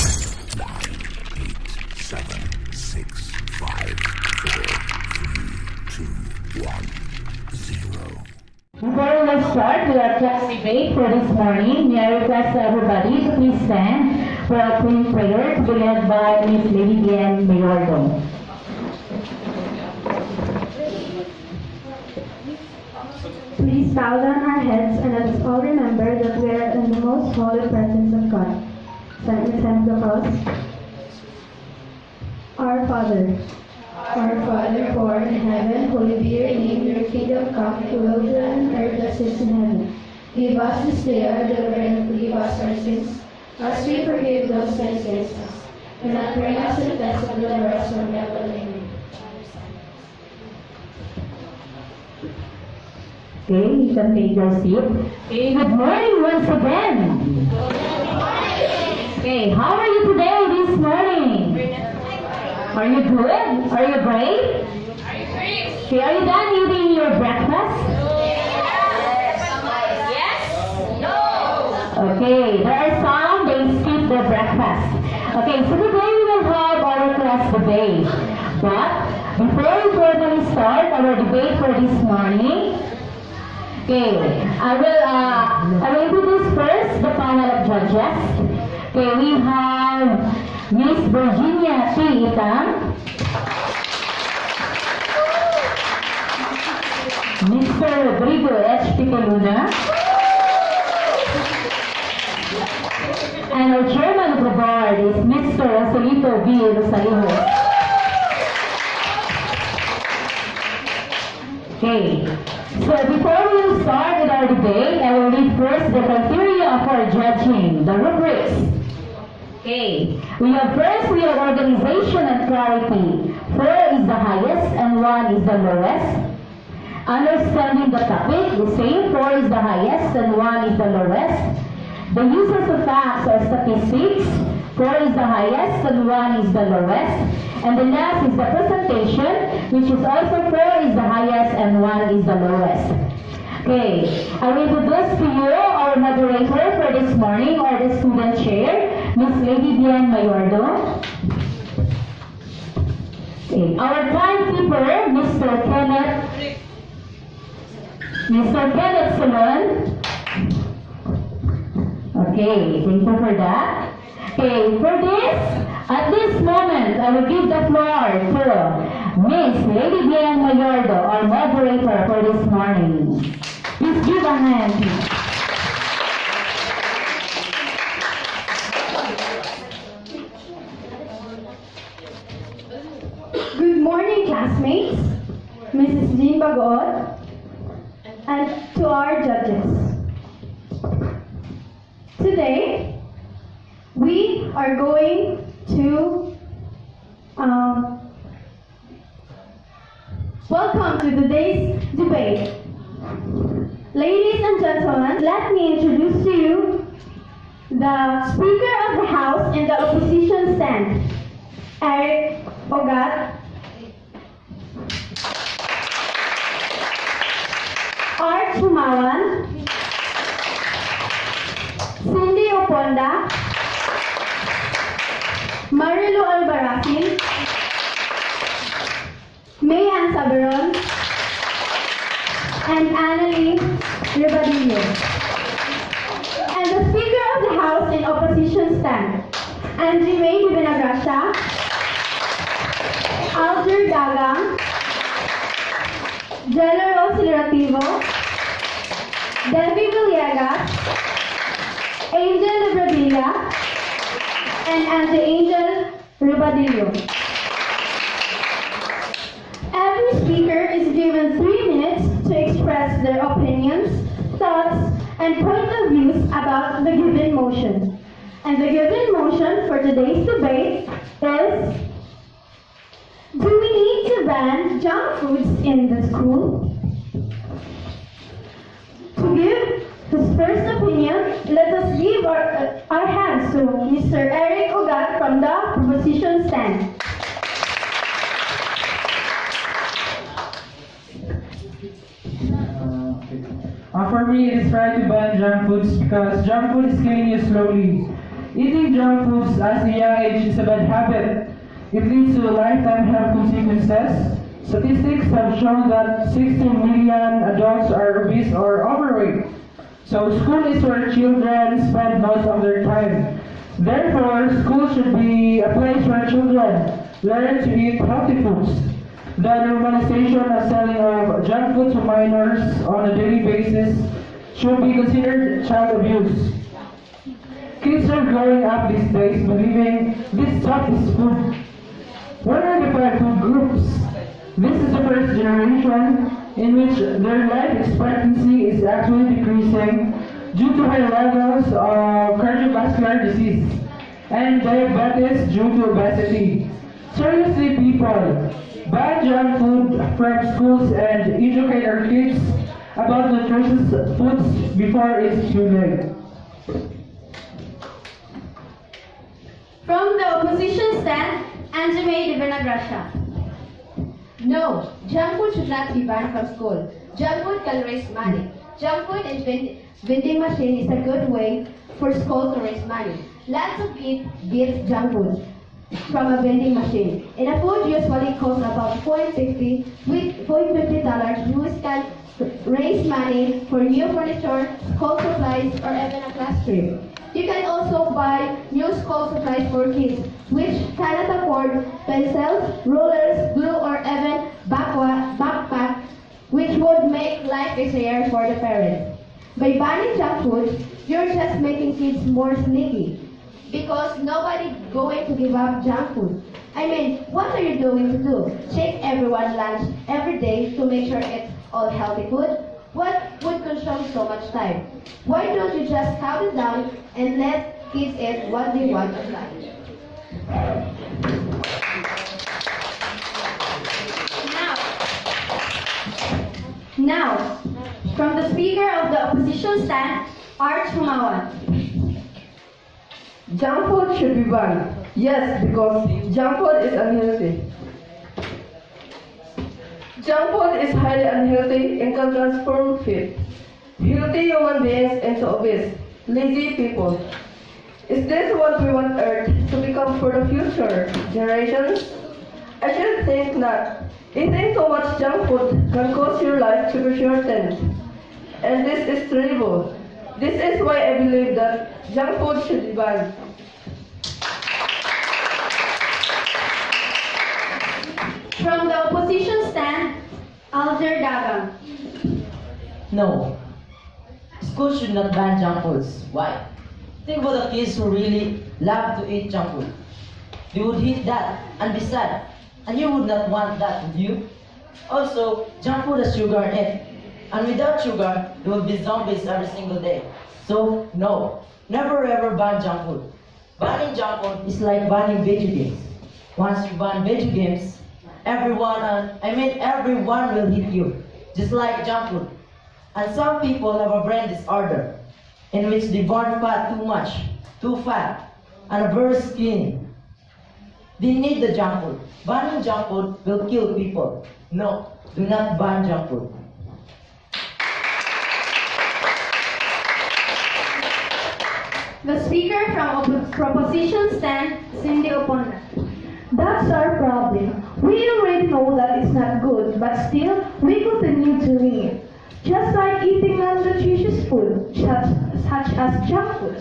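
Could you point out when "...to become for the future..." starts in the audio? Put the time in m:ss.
7:29.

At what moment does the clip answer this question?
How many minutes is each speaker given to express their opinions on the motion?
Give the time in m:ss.
4:21.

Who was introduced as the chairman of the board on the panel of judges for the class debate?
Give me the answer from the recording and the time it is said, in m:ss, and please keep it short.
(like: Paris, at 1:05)
Rosalito B. Rosalijo, at 1:45.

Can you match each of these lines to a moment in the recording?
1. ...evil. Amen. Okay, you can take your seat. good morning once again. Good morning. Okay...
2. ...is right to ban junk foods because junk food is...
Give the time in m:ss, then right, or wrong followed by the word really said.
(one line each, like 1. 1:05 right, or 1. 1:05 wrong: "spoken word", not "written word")
1. 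0:48 right
2. 4:54 right.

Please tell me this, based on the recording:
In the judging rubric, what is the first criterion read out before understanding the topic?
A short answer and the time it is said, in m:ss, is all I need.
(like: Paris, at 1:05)
Organization and clarity, at 2:01.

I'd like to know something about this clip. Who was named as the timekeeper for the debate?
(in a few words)
Kenneth Solon.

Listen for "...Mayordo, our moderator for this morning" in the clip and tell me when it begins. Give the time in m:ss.
2:50.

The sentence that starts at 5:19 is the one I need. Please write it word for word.
The normalization of selling of junk food to minors on a daily basis should be considered child abuse.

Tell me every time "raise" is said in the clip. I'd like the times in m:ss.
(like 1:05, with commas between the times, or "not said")
6:07, 6:12, 6:22.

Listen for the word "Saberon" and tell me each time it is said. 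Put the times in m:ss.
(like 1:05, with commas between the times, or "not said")
3:50.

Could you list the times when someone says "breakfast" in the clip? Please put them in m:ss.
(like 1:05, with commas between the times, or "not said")
1:07, 1:14.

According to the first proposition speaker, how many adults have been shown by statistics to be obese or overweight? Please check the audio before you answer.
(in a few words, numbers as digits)
16 million.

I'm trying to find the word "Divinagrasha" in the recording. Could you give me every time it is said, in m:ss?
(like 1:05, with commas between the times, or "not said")
4:00, 6:02.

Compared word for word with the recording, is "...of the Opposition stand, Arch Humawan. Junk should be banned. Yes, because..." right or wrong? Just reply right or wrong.
right.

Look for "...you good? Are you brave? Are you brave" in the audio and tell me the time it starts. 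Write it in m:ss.
1:02.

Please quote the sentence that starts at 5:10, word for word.
So school is where children spend most of their time.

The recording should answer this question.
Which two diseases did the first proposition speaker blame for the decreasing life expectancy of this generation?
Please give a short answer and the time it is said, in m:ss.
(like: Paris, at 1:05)
cardiovascular disease and diabetes, at 5:42.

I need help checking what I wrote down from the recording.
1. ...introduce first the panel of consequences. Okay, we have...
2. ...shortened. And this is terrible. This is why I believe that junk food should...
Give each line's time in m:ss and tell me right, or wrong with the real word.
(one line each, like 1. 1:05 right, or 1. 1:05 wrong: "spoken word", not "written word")
1. 1:26 wrong: "judges", not "consequences"
2. 7:37 right.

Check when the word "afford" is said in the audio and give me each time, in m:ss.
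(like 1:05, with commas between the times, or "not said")
6:31.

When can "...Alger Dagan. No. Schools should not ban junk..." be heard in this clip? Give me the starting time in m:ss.
7:50.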